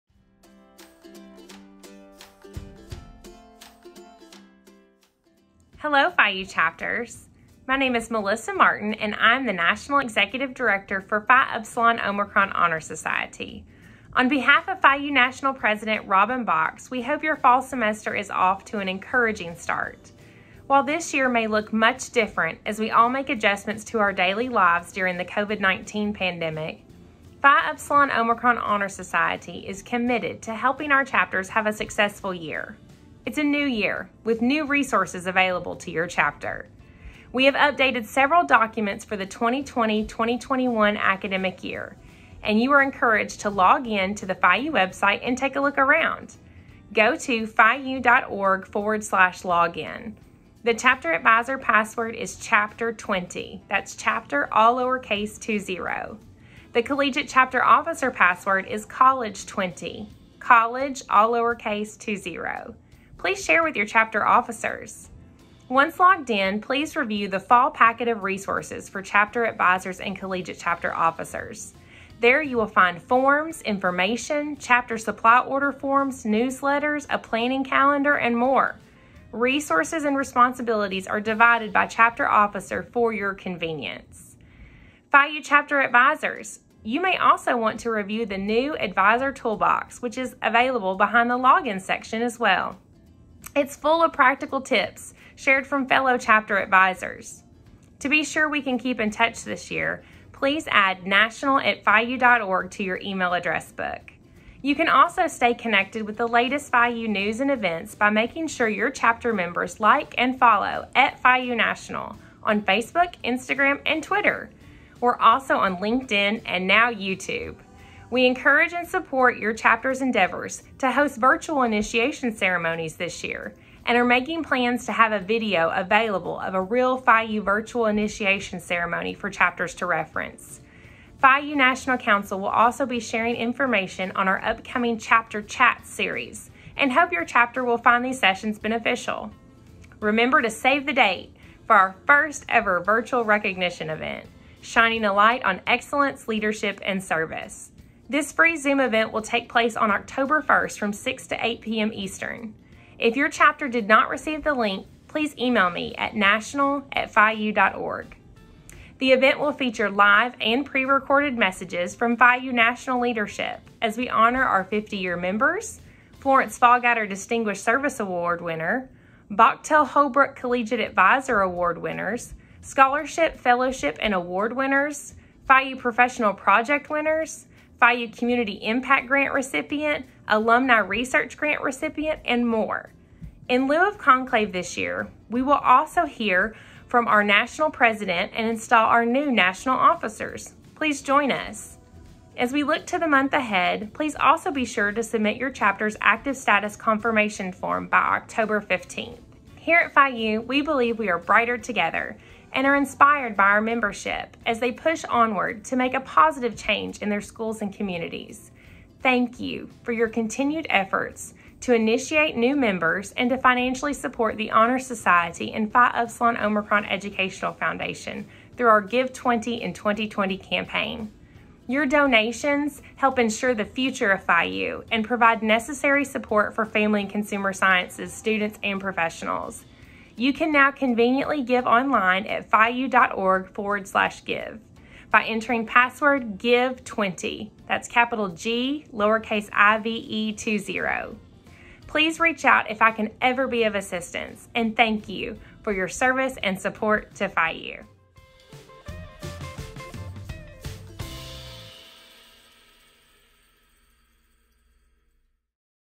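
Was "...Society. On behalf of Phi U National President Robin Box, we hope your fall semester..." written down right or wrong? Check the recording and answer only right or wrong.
right.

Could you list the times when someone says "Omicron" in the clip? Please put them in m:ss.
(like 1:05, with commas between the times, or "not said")
0:11, 0:28, 3:36.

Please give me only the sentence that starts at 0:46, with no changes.
Go to phiu.org forward slash login.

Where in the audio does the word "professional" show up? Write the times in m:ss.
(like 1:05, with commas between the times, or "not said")
2:55, 3:48.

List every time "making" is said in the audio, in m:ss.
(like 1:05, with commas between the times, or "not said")
1:48, 2:04.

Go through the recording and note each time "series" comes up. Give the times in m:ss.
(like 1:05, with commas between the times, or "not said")
2:15.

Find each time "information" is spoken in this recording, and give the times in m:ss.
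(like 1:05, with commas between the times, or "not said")
1:13, 2:13.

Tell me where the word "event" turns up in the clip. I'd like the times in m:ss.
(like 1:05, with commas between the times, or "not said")
1:47, 2:23, 2:28, 2:39.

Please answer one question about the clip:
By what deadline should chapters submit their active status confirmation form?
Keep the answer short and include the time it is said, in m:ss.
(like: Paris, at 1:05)
October 15, at 3:17.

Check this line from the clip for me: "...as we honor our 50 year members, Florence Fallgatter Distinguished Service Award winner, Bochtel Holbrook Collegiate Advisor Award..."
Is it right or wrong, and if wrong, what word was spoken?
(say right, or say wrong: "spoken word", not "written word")
right.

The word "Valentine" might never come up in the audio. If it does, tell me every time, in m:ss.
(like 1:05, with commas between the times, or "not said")
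not said.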